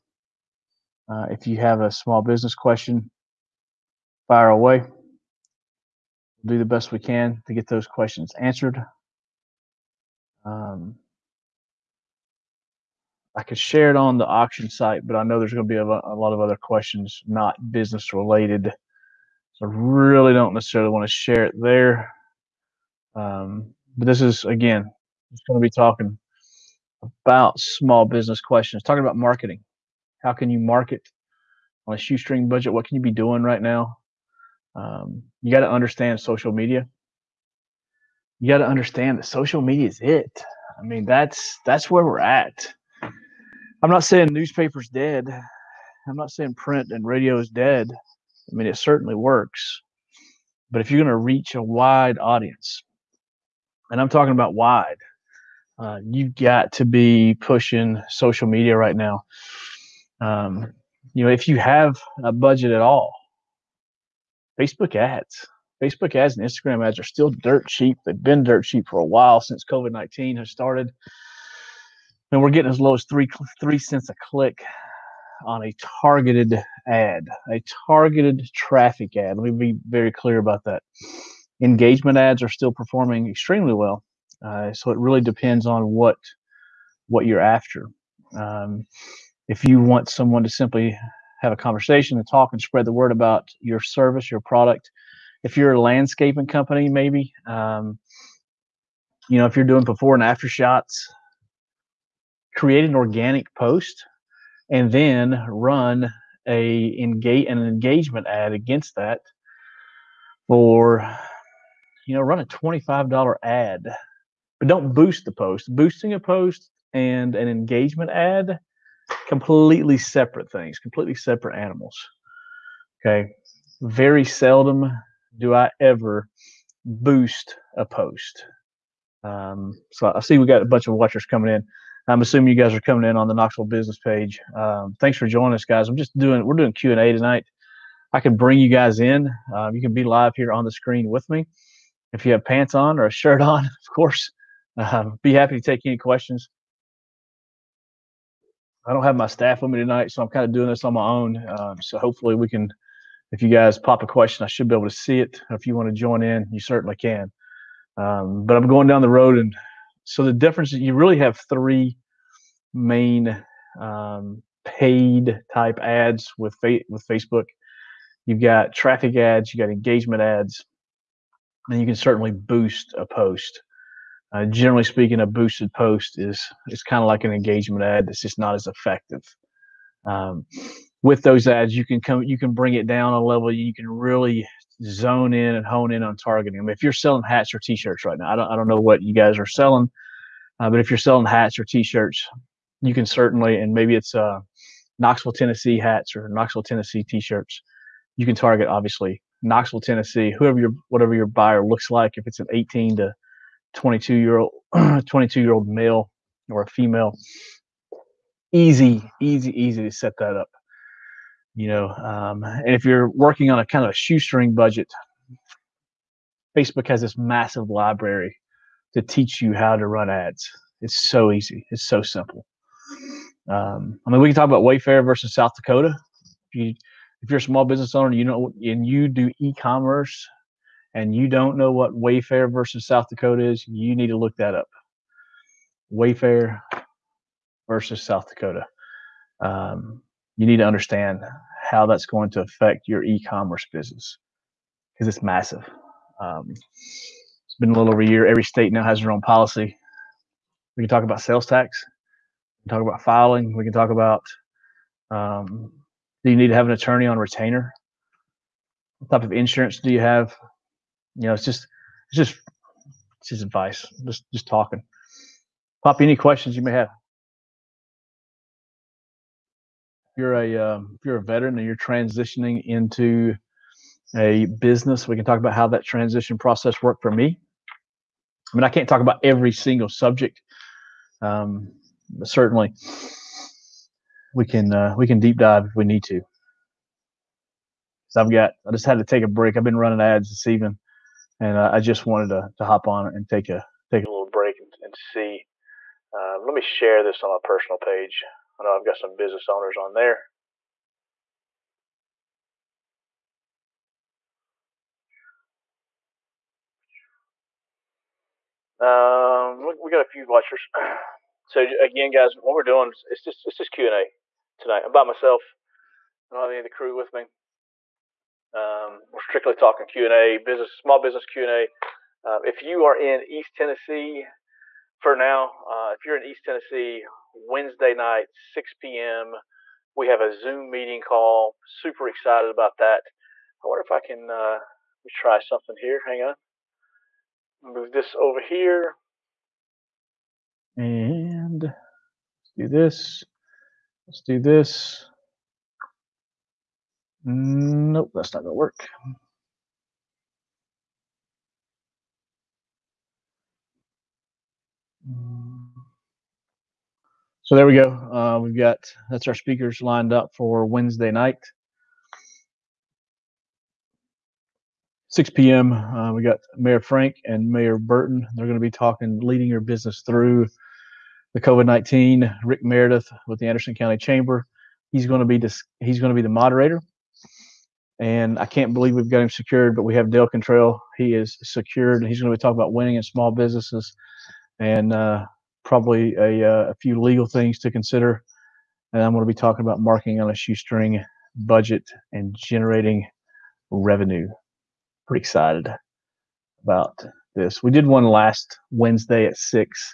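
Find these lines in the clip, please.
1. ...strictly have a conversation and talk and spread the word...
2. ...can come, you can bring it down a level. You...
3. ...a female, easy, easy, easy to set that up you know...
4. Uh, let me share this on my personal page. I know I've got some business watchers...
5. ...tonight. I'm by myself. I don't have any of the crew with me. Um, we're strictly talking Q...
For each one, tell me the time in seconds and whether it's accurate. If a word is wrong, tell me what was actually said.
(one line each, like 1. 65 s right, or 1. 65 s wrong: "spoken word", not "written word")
1. 90 s wrong: "simply", not "strictly"
2. 181 s right
3. 206 s right
4. 296 s wrong: "owners", not "watchers"
5. 314 s right.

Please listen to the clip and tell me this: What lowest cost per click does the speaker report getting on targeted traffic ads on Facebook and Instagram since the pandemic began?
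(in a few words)
3 cents.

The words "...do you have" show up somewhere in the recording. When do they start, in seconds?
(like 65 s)
259 s.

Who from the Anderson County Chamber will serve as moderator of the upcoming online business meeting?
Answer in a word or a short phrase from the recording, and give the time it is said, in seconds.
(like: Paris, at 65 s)
Rick Meredith, at 372 s.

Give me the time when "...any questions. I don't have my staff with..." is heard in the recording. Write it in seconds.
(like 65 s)
145 s.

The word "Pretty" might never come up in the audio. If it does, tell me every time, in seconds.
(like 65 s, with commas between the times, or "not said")
395 s.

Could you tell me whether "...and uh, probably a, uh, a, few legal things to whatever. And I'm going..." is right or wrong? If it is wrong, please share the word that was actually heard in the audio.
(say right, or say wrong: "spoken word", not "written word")
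wrong: "consider", not "whatever".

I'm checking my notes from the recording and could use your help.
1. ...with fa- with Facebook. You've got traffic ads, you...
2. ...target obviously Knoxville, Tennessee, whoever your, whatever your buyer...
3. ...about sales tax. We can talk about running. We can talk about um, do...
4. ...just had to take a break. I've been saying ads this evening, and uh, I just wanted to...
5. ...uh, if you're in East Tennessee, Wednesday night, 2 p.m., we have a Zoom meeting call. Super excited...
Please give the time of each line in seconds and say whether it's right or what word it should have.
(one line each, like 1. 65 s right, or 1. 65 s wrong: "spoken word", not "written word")
1. 166 s right
2. 198 s right
3. 251 s wrong: "filing", not "running"
4. 288 s wrong: "running", not "saying"
5. 325 s wrong: "6", not "2".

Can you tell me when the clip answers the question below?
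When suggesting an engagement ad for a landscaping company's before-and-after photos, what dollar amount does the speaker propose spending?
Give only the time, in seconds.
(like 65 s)
112 s.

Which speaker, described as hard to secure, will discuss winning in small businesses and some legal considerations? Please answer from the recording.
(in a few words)
Dale Cantrell.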